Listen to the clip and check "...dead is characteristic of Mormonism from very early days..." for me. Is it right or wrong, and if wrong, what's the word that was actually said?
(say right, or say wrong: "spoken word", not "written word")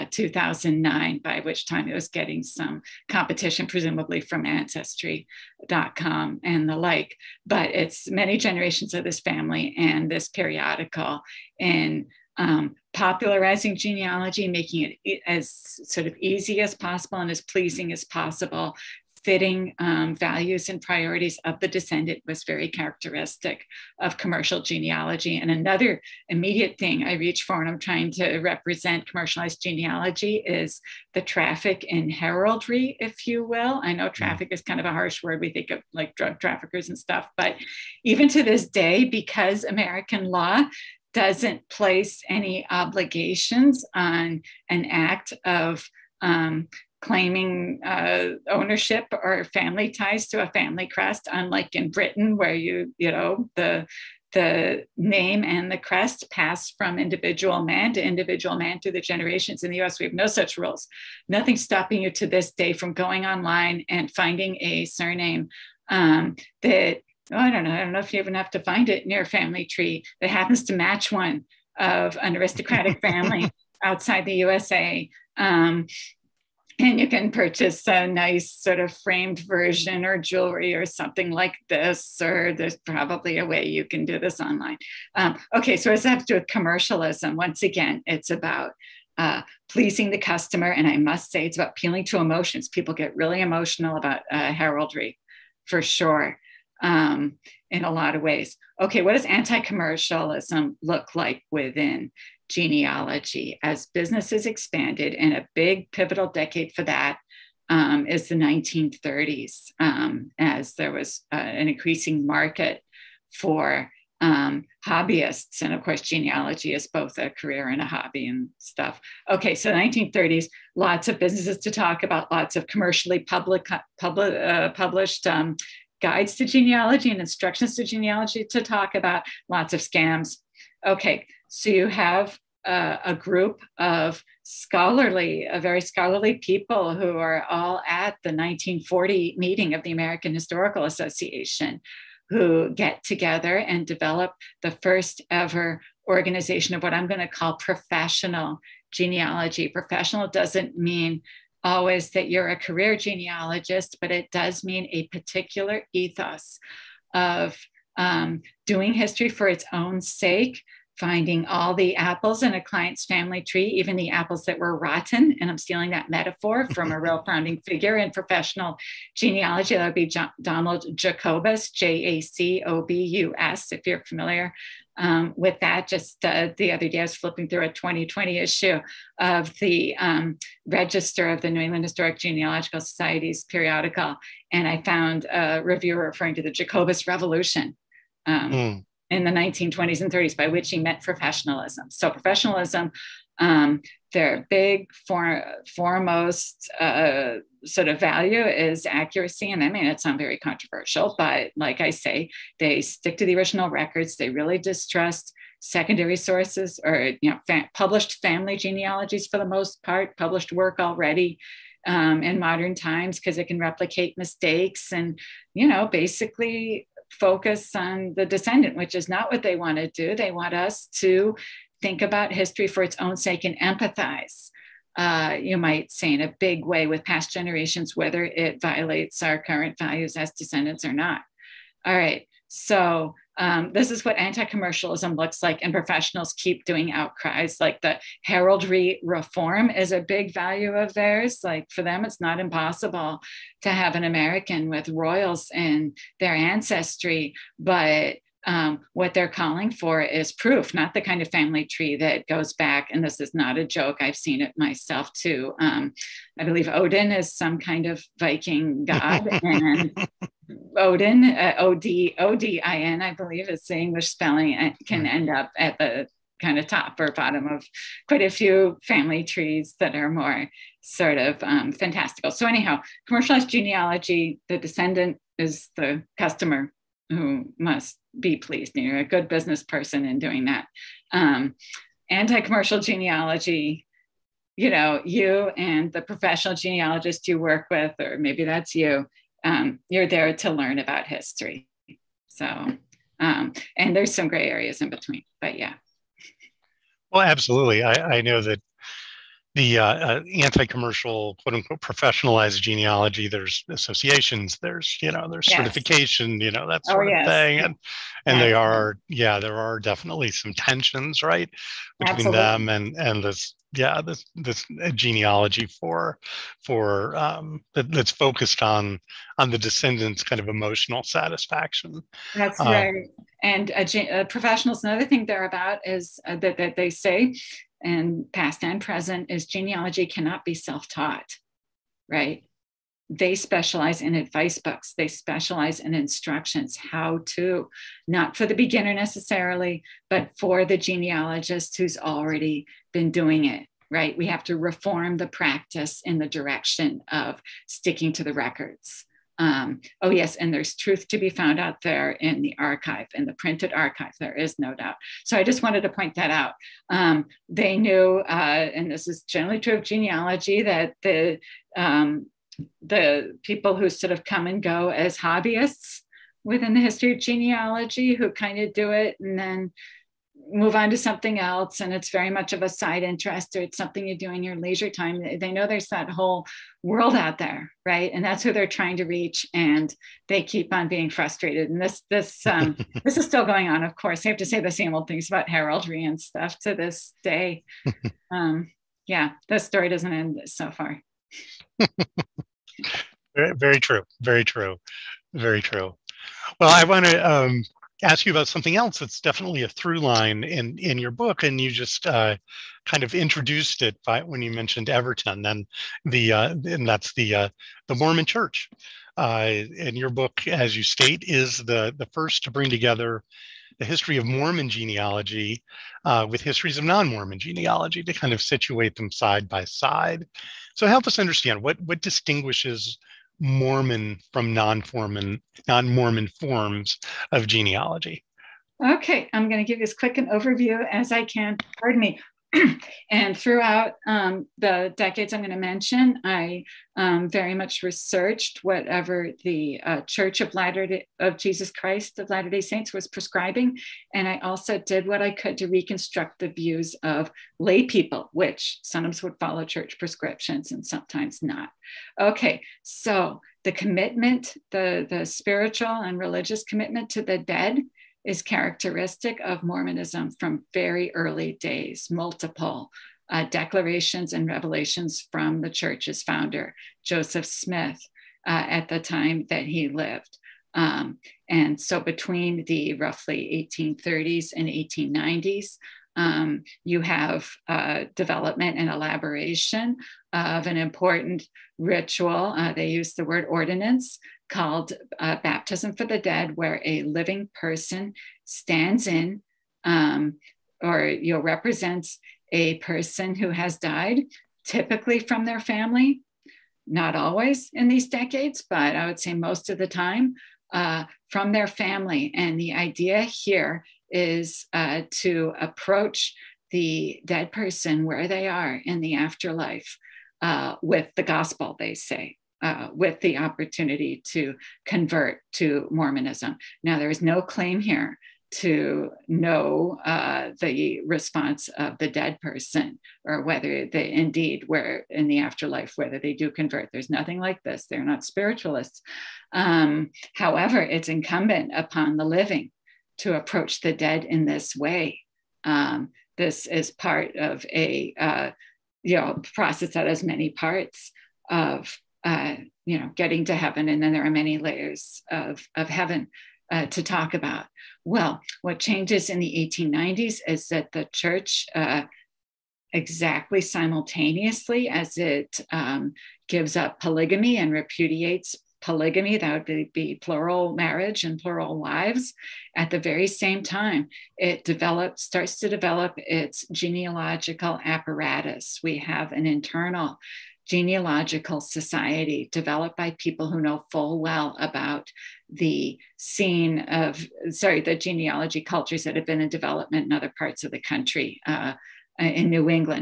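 right.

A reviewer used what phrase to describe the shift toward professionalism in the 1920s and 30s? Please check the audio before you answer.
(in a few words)
the Jacobus Revolution.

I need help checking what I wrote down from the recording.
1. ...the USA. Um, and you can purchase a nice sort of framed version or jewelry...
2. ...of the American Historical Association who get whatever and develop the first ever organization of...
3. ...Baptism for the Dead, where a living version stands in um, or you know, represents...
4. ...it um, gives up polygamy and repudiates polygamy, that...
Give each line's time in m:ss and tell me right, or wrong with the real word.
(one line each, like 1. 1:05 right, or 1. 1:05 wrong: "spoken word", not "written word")
1. 1:14 right
2. 2:19 wrong: "together", not "whatever"
3. 8:05 wrong: "person", not "version"
4. 9:15 right.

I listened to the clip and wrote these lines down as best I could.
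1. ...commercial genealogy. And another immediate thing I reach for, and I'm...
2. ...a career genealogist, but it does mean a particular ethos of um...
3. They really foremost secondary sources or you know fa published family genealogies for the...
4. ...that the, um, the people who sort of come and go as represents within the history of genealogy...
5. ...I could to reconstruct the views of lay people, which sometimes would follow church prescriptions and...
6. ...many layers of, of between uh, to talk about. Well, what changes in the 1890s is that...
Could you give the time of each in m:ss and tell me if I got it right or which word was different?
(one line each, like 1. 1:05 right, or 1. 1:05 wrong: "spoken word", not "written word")
1. 0:24 right
2. 2:32 right
3. 3:24 wrong: "distrust", not "foremost"
4. 6:00 wrong: "hobbyists", not "represents"
5. 7:25 right
6. 9:04 wrong: "heaven", not "between".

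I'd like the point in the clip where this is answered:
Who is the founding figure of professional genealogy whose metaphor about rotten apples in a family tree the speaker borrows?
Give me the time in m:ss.
2:50.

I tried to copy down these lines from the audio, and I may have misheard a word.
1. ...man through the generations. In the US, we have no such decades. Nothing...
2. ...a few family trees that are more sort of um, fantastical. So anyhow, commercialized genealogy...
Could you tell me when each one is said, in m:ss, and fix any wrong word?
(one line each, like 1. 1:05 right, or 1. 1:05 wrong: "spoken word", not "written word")
1. 0:58 wrong: "rules", not "decades"
2. 4:28 right.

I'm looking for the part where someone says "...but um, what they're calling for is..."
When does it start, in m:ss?
4:07.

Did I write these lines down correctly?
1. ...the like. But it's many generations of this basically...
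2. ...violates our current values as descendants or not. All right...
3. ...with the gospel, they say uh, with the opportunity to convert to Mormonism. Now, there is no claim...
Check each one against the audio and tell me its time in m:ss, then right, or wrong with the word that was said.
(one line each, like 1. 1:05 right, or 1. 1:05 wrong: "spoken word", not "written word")
1. 0:06 wrong: "family", not "basically"
2. 3:48 right
3. 8:30 right.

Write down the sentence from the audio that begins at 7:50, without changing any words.
Um, and so between the roughly 1830s and 1890s, um, you have uh, development and elaboration of an important ritual.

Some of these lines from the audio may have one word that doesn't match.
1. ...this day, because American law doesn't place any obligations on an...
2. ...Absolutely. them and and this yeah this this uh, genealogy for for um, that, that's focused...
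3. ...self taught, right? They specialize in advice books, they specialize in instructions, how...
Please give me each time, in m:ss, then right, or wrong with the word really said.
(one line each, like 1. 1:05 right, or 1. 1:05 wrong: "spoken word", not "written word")
1. 0:38 right
2. 5:12 right
3. 5:30 right.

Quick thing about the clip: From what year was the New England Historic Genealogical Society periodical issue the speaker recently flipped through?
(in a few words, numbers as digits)
2020.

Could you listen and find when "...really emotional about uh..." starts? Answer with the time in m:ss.
1:33.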